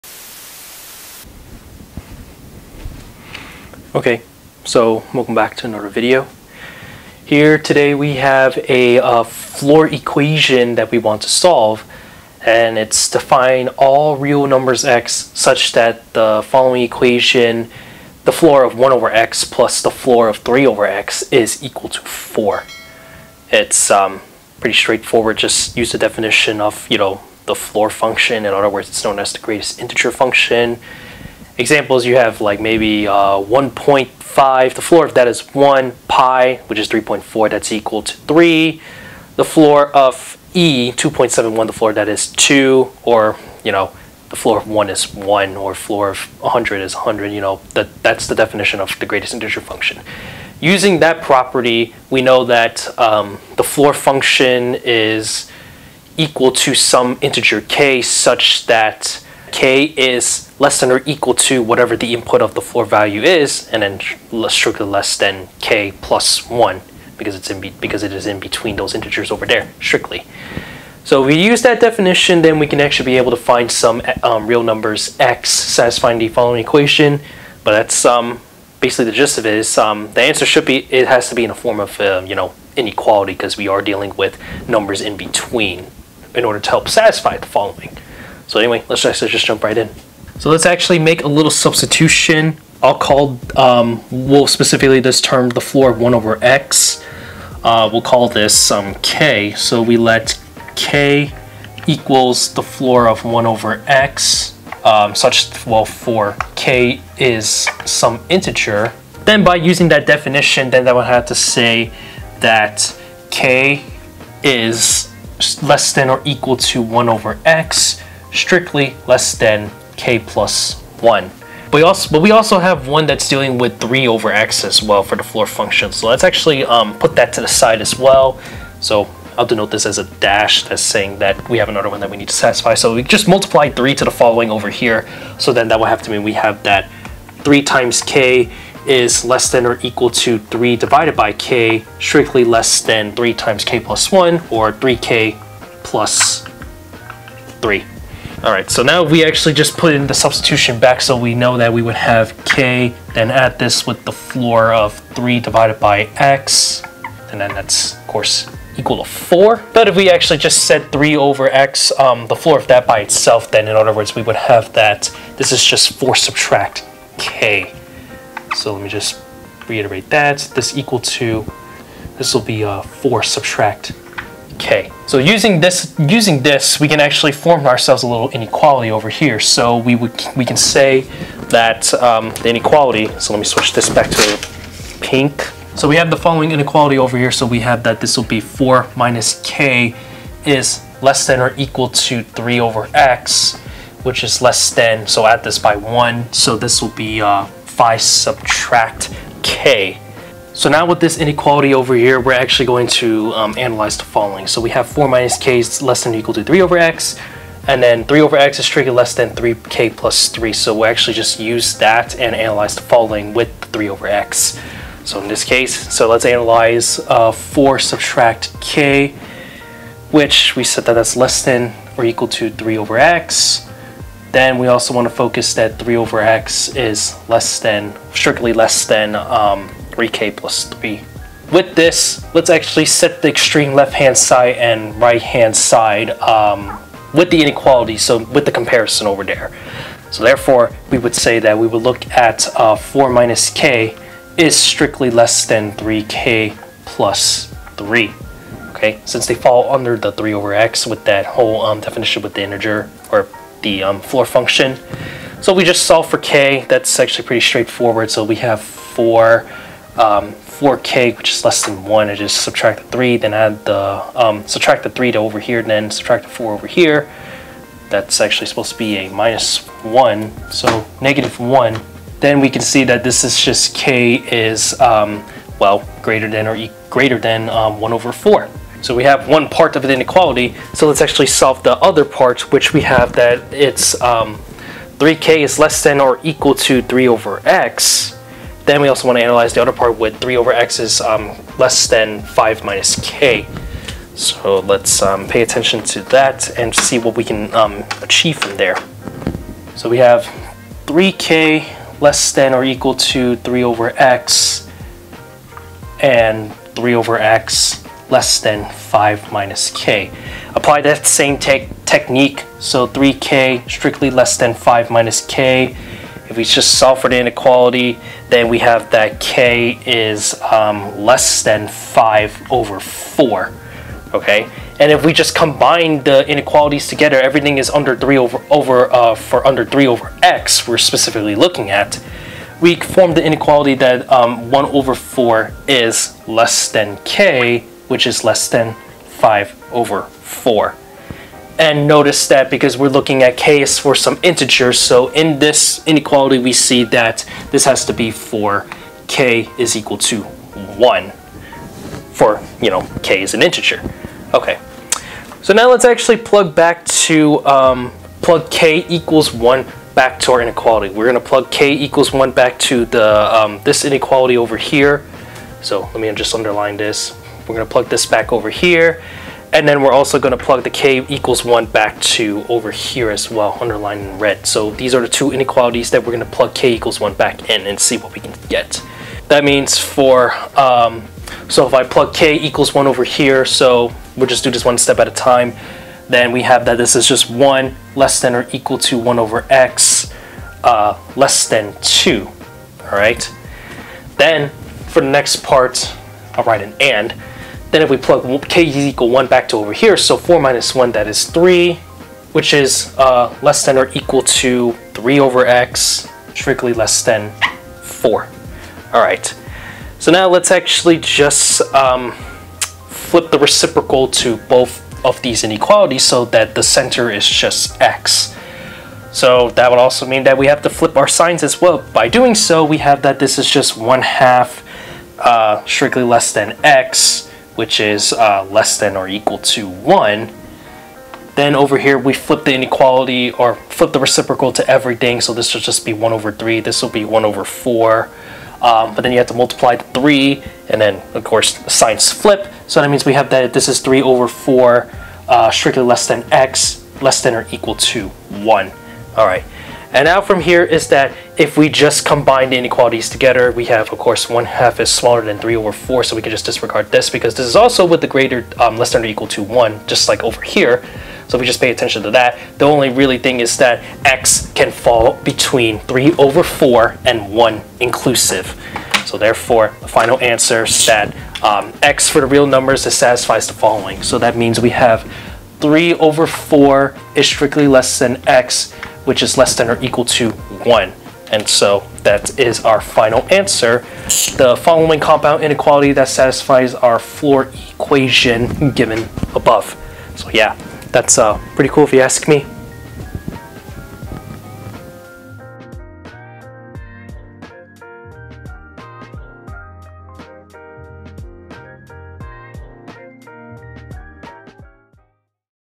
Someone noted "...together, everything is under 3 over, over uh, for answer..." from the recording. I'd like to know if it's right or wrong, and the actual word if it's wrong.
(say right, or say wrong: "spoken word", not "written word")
wrong: "under", not "answer".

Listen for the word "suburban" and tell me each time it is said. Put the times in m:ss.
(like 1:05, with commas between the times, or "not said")
not said.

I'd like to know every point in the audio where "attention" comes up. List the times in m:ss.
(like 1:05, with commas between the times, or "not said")
4:55, 7:41.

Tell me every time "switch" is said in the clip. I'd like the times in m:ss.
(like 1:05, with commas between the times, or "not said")
3:03.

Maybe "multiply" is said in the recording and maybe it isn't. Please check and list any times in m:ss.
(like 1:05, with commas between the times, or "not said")
2:13, 7:19.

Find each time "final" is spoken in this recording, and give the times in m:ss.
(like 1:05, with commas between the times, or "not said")
7:49, 8:02.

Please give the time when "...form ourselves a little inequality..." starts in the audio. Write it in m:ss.
2:57.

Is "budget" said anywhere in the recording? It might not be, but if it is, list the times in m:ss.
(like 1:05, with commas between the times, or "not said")
not said.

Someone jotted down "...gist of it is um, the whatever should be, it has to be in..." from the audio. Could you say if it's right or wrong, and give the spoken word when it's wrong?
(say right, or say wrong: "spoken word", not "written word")
wrong: "answer", not "whatever".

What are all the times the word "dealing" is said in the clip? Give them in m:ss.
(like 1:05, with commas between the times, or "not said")
1:23, 2:03.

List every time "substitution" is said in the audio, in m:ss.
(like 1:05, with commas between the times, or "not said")
1:31, 2:30.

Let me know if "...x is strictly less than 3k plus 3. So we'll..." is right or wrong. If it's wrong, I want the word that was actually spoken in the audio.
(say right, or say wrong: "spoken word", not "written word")
right.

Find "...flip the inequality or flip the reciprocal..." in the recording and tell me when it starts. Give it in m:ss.
7:12.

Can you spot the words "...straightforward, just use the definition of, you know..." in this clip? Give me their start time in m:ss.
0:24.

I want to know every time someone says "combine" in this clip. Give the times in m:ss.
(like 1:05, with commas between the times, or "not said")
5:25, 7:32.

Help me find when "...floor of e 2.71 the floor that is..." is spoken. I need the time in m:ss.
0:39.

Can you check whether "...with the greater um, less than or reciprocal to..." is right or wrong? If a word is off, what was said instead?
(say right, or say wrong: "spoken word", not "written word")
wrong: "equal", not "reciprocal".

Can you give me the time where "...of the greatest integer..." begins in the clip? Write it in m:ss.
0:48.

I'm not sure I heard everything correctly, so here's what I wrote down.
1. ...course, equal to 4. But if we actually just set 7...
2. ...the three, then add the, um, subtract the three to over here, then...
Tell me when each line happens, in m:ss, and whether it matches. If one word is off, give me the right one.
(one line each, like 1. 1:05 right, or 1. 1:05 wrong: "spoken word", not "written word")
1. 2:38 wrong: "3", not "7"
2. 4:22 right.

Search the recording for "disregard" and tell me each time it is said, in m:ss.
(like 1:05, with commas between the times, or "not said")
7:36.